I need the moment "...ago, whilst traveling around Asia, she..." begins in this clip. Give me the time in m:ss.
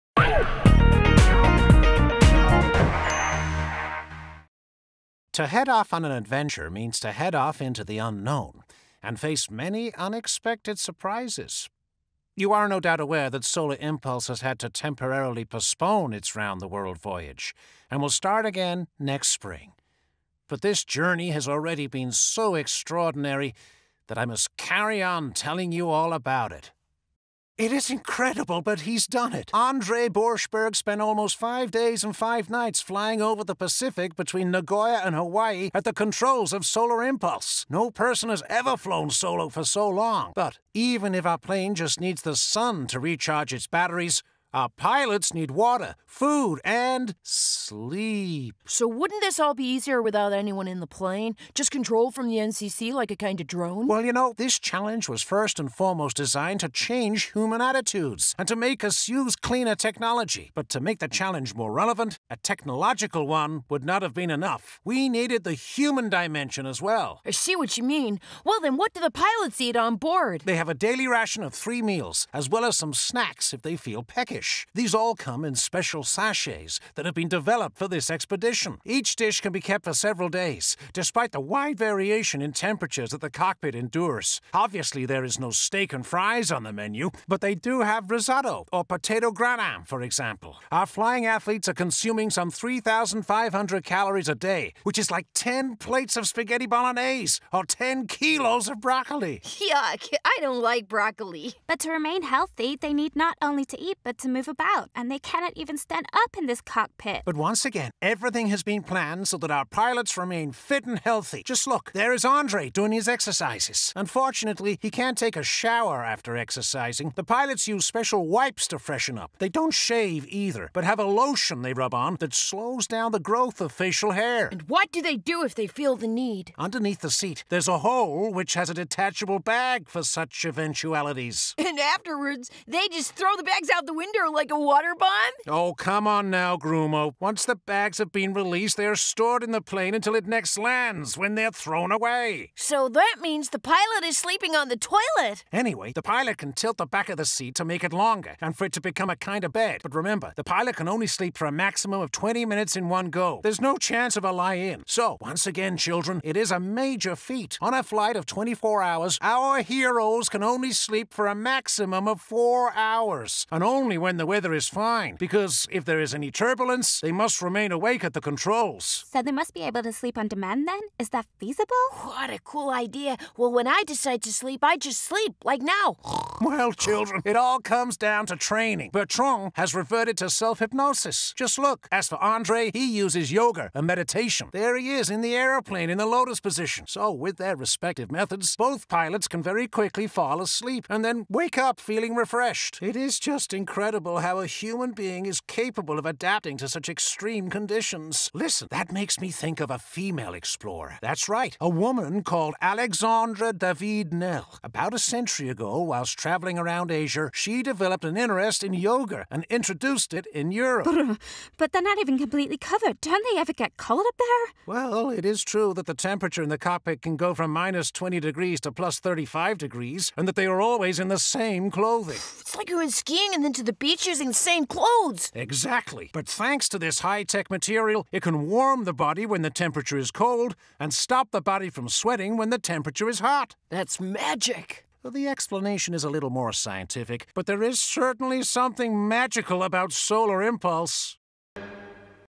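3:25.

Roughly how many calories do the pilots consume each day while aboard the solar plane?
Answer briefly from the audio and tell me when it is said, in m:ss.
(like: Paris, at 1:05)
3,500, at 1:32.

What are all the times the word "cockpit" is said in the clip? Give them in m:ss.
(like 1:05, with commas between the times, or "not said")
1:23, 1:46, 3:36.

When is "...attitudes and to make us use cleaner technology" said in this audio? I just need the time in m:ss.
0:57.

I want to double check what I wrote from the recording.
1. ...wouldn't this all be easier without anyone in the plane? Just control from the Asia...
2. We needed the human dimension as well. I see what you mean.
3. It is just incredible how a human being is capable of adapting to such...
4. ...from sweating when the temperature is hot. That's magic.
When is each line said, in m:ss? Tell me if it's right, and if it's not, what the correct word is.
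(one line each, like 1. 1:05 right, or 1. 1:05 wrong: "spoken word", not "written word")
1. 0:48 wrong: "NCC", not "Asia"
2. 1:04 right
3. 3:12 right
4. 3:51 right.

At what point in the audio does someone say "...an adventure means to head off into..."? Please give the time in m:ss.
0:06.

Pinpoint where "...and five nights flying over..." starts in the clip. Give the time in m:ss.
0:32.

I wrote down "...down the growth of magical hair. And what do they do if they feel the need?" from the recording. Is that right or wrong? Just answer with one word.
wrong.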